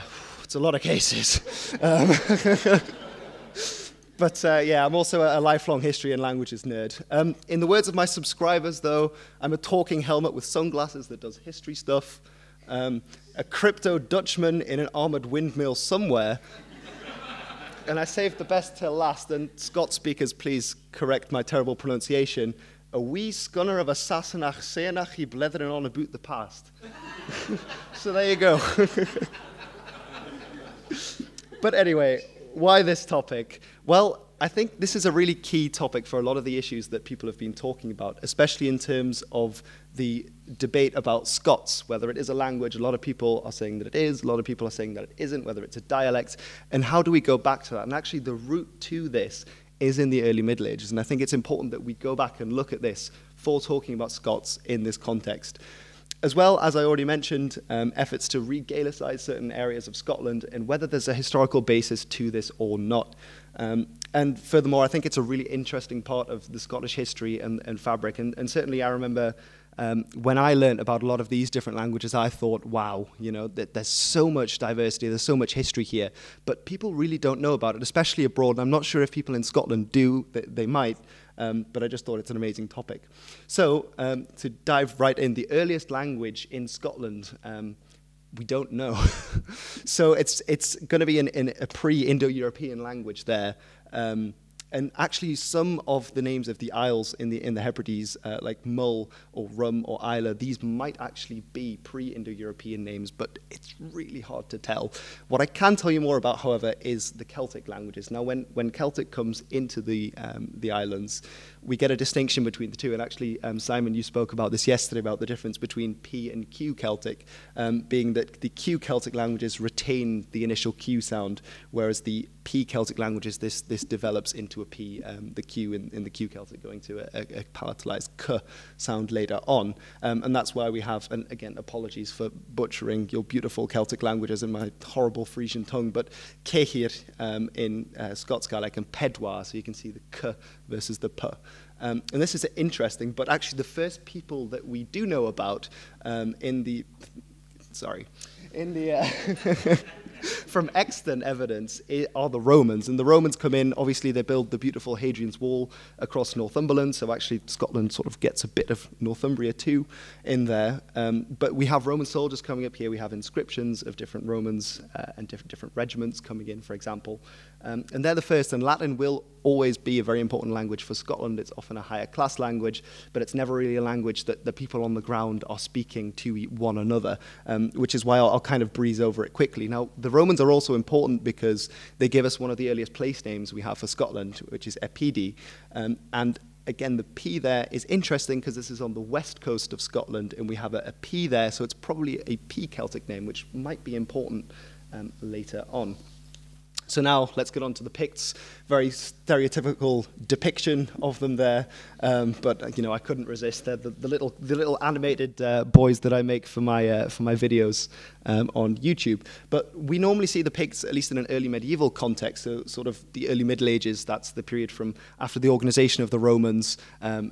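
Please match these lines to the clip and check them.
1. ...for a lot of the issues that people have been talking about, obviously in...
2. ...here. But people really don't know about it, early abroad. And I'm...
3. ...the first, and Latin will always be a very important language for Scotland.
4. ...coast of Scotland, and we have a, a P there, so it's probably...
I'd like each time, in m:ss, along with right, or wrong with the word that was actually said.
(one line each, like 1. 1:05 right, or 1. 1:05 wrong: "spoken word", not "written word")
1. 0:36 wrong: "especially", not "obviously"
2. 1:15 wrong: "especially", not "early"
3. 2:48 right
4. 3:09 right.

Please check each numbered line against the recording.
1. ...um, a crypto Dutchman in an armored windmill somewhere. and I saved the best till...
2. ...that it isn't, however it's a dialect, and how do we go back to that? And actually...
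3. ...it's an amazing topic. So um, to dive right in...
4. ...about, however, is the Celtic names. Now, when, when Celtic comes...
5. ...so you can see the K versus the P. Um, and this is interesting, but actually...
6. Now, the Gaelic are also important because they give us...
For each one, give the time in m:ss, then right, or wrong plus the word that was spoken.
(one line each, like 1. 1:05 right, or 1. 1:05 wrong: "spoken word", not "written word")
1. 0:12 right
2. 0:44 wrong: "whether", not "however"
3. 1:22 right
4. 1:46 wrong: "languages", not "names"
5. 2:19 right
6. 2:59 wrong: "Romans", not "Gaelic".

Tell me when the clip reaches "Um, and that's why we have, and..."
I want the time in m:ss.
2:10.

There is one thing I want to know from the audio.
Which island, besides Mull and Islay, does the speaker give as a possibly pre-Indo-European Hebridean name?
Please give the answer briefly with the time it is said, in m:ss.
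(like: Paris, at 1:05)
Rum, at 1:39.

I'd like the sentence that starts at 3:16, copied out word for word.
So now let's get on to the Picts.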